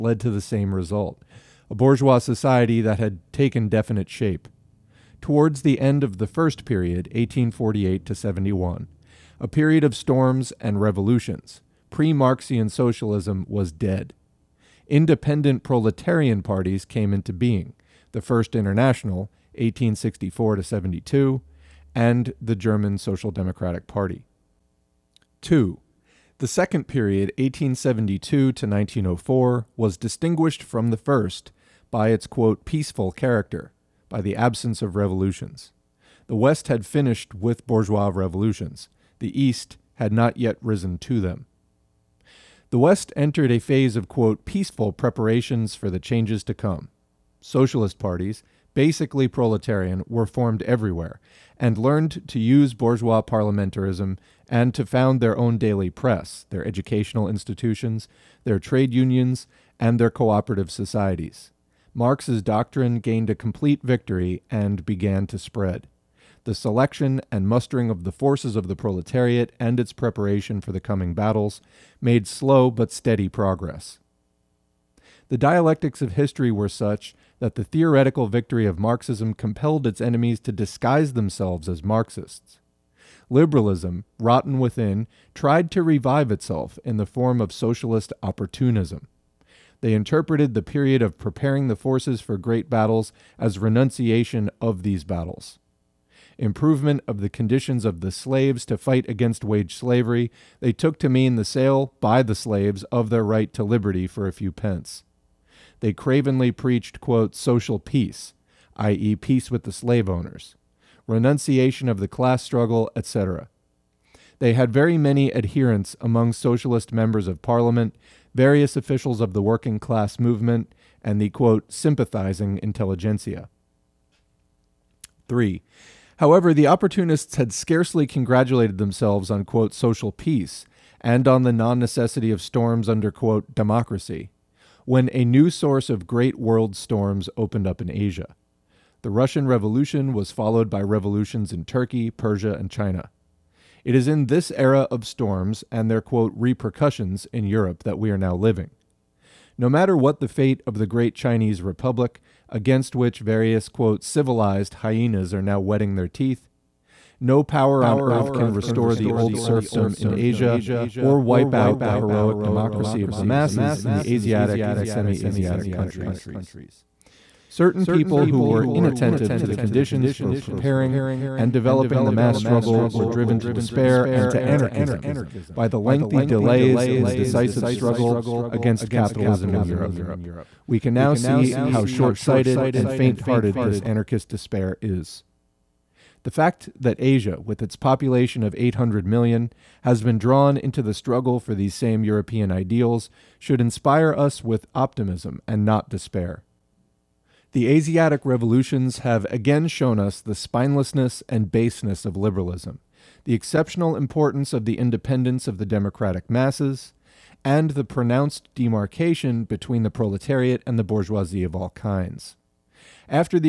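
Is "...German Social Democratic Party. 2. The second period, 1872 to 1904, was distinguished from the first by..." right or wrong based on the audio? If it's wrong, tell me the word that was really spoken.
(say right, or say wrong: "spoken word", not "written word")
right.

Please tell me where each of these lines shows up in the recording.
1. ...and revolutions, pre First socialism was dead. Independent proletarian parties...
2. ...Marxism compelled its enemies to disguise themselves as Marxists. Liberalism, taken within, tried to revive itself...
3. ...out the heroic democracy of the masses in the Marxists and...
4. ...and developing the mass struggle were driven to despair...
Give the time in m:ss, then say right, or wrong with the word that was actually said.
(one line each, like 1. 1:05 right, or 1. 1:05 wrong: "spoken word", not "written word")
1. 0:10 wrong: "Marxian", not "First"
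2. 1:18 wrong: "rotten", not "taken"
3. 2:41 wrong: "Asiatic", not "Marxists"
4. 2:51 right.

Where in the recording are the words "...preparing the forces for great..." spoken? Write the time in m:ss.
1:31.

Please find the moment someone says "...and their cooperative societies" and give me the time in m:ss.
0:59.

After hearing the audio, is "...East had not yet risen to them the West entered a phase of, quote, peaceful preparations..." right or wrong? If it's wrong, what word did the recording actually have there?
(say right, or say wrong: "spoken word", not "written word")
right.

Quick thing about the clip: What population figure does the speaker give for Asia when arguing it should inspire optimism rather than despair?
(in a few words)
800 million.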